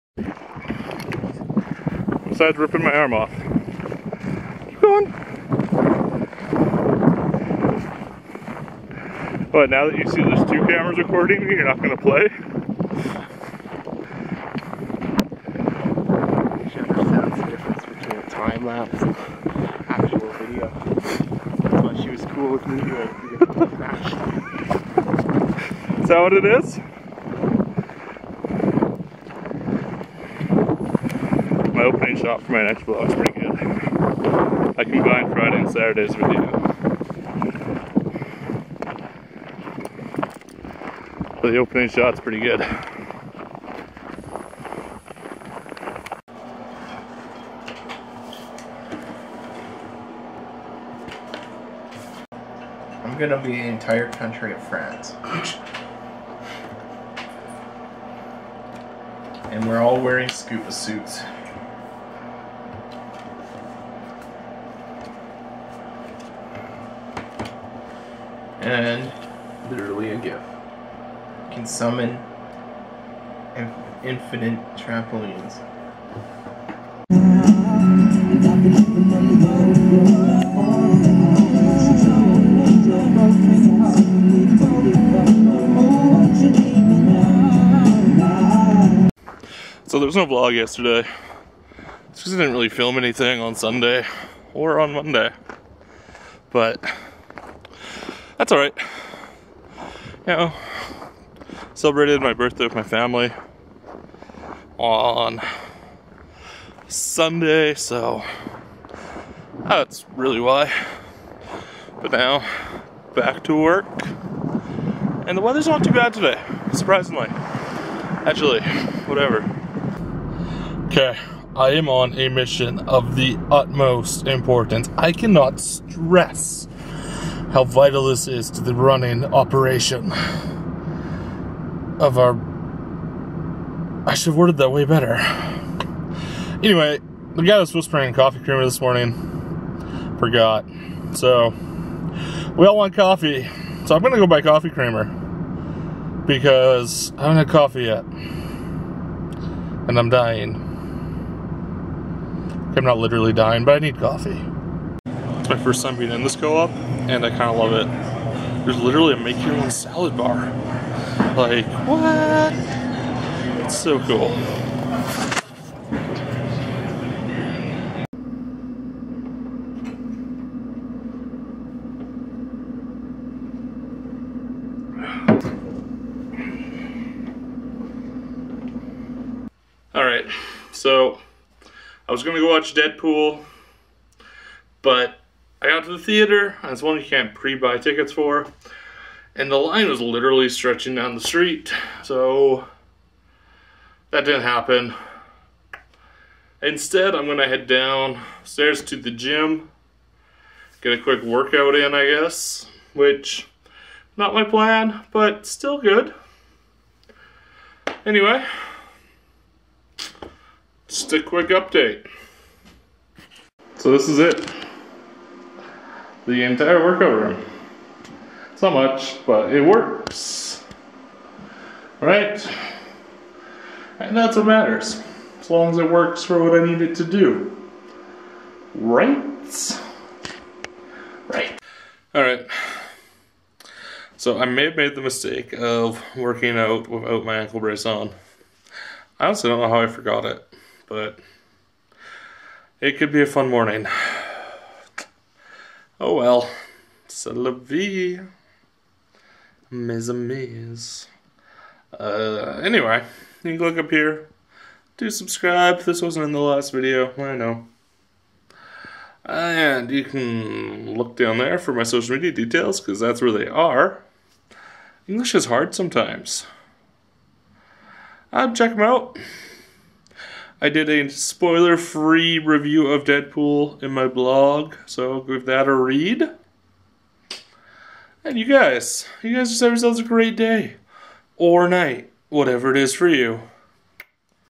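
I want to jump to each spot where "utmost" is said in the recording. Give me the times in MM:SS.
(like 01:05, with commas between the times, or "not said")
02:03.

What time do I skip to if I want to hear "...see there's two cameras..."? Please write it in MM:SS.
00:10.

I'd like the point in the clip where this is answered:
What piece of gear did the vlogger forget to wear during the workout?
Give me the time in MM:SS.
03:57.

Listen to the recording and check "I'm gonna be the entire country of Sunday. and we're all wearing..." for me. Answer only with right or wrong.
wrong.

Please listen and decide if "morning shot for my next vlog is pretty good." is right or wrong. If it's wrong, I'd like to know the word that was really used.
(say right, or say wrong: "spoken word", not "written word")
right.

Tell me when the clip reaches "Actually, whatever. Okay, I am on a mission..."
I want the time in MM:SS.
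01:58.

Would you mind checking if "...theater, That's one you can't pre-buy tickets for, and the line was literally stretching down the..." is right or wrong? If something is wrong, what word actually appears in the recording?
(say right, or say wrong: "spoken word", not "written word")
right.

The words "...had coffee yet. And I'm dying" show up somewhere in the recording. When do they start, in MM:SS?
02:27.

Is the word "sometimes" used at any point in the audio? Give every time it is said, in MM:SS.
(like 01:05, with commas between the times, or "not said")
04:25.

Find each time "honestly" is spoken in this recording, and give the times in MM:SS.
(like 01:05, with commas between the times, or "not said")
03:59.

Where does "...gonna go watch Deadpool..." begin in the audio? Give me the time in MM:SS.
03:02.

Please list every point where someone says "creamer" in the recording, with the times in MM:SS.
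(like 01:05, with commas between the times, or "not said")
02:18, 02:24.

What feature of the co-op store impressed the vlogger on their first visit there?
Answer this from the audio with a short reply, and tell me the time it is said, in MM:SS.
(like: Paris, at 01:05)
make your own salad bar, at 02:39.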